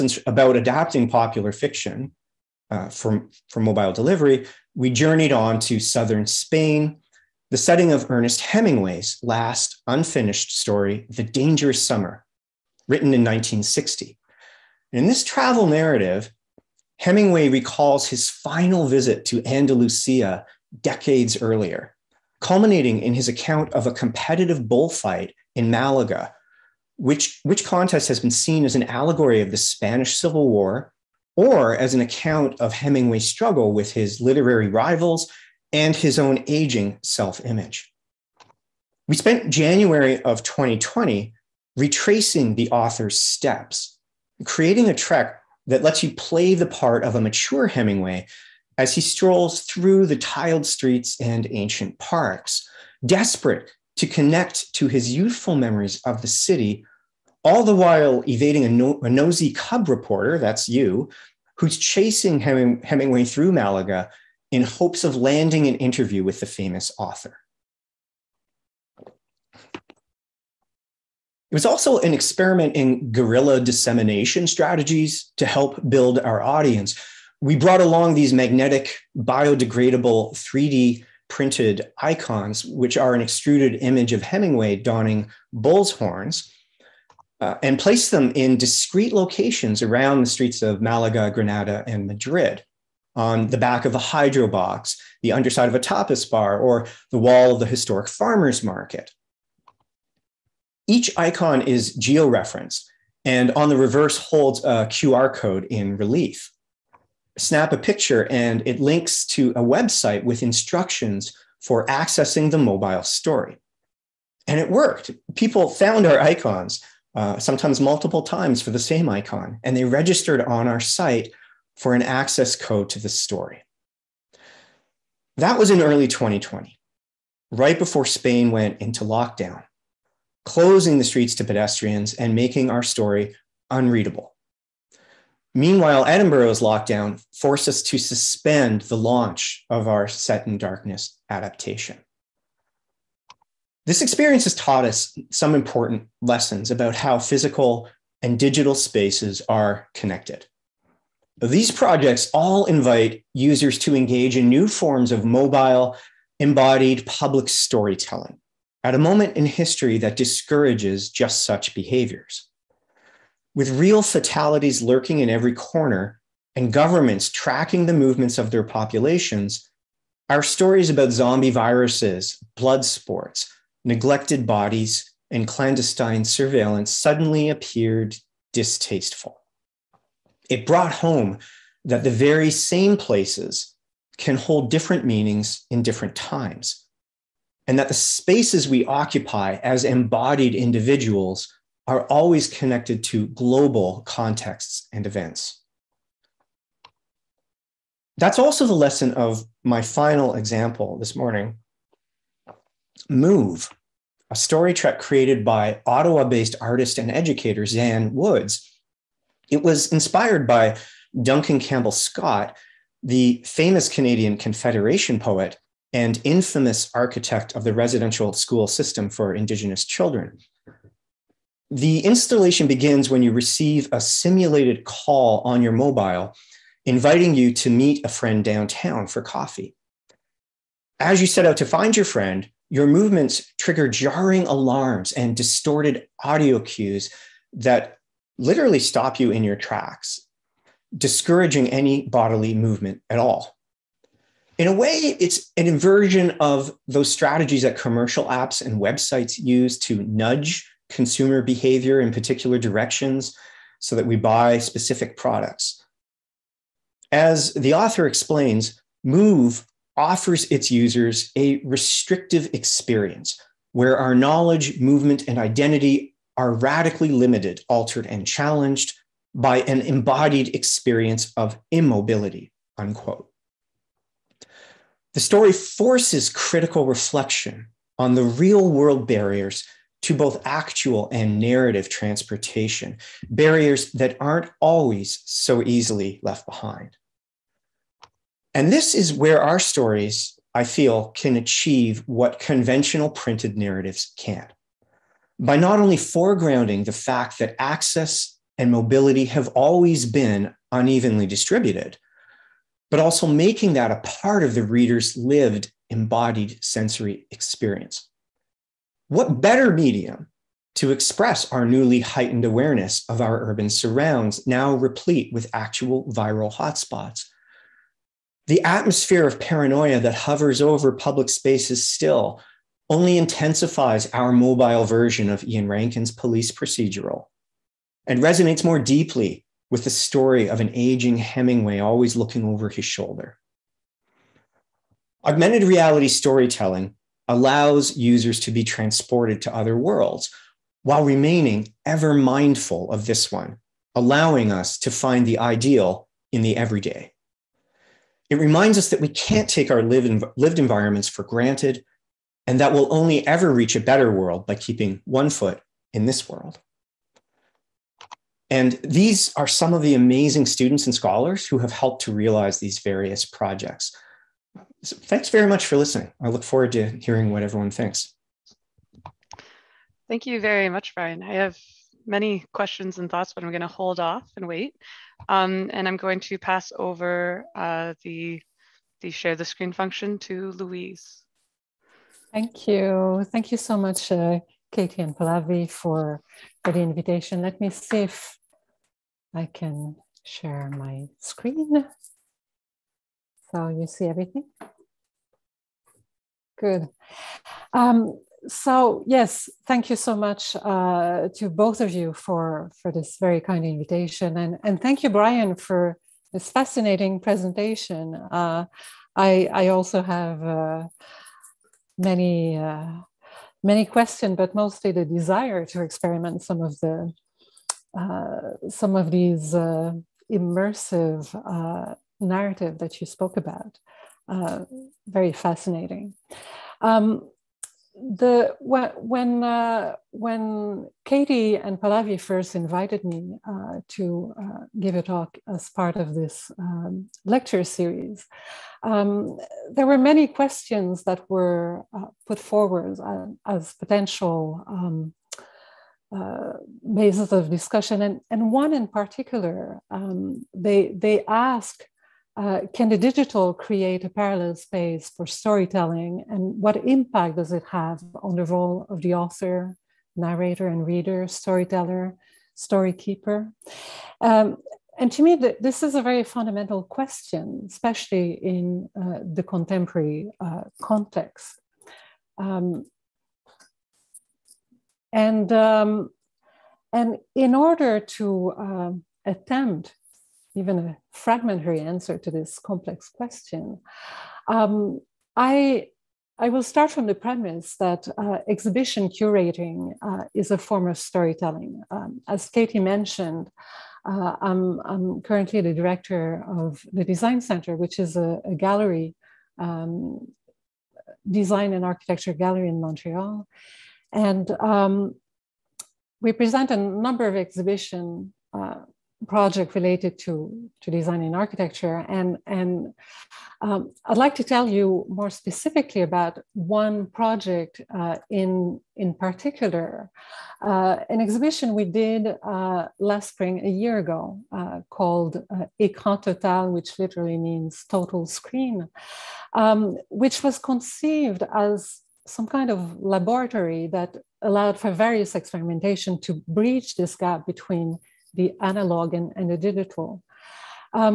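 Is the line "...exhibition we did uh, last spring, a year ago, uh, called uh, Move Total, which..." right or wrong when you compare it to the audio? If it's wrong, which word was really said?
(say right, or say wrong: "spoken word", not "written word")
wrong: "Écran", not "Move".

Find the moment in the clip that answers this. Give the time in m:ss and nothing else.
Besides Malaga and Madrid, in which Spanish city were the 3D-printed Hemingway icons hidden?
1:31.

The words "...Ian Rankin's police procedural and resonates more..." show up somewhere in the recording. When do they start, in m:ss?
5:25.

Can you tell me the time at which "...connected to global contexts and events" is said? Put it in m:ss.
3:12.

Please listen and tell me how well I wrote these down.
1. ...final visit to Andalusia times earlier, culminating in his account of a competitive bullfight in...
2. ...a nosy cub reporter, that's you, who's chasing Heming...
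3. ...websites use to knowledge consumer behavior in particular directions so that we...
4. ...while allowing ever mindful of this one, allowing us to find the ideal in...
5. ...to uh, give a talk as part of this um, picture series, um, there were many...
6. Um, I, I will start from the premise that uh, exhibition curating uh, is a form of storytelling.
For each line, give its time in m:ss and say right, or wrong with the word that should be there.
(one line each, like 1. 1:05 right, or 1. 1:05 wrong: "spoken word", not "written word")
1. 0:18 wrong: "decades", not "times"
2. 0:59 right
3. 4:08 wrong: "nudge", not "knowledge"
4. 5:40 wrong: "remaining", not "allowing"
5. 7:13 wrong: "lecture", not "picture"
6. 8:04 right.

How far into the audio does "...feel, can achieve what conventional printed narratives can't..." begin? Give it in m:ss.
4:50.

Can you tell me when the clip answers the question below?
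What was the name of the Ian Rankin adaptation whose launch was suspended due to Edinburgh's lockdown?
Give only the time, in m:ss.
2:20.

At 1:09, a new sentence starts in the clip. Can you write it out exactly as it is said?
It was also an experiment in guerrilla dissemination strategies to help build our audience.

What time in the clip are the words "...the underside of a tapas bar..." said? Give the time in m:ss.
1:35.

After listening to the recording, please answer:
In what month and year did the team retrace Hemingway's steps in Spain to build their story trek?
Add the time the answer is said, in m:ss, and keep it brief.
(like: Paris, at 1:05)
January 2020, at 0:39.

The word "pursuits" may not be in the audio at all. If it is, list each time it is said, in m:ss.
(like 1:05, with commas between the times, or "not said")
not said.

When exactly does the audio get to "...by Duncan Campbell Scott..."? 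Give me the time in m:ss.
3:30.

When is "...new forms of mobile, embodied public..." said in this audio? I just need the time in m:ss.
2:34.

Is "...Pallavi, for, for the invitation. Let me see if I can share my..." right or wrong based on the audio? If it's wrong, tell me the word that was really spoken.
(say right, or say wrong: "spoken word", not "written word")
right.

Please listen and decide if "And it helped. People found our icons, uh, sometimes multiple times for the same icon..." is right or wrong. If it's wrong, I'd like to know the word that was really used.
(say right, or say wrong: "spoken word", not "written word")
wrong: "worked", not "helped".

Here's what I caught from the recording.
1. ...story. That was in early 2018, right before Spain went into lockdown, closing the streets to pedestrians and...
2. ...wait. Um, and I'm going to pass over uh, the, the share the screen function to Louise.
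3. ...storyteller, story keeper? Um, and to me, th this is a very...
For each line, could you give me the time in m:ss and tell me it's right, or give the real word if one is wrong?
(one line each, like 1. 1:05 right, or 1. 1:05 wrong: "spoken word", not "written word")
1. 2:03 wrong: "2020", not "2018"
2. 6:14 right
3. 7:41 right.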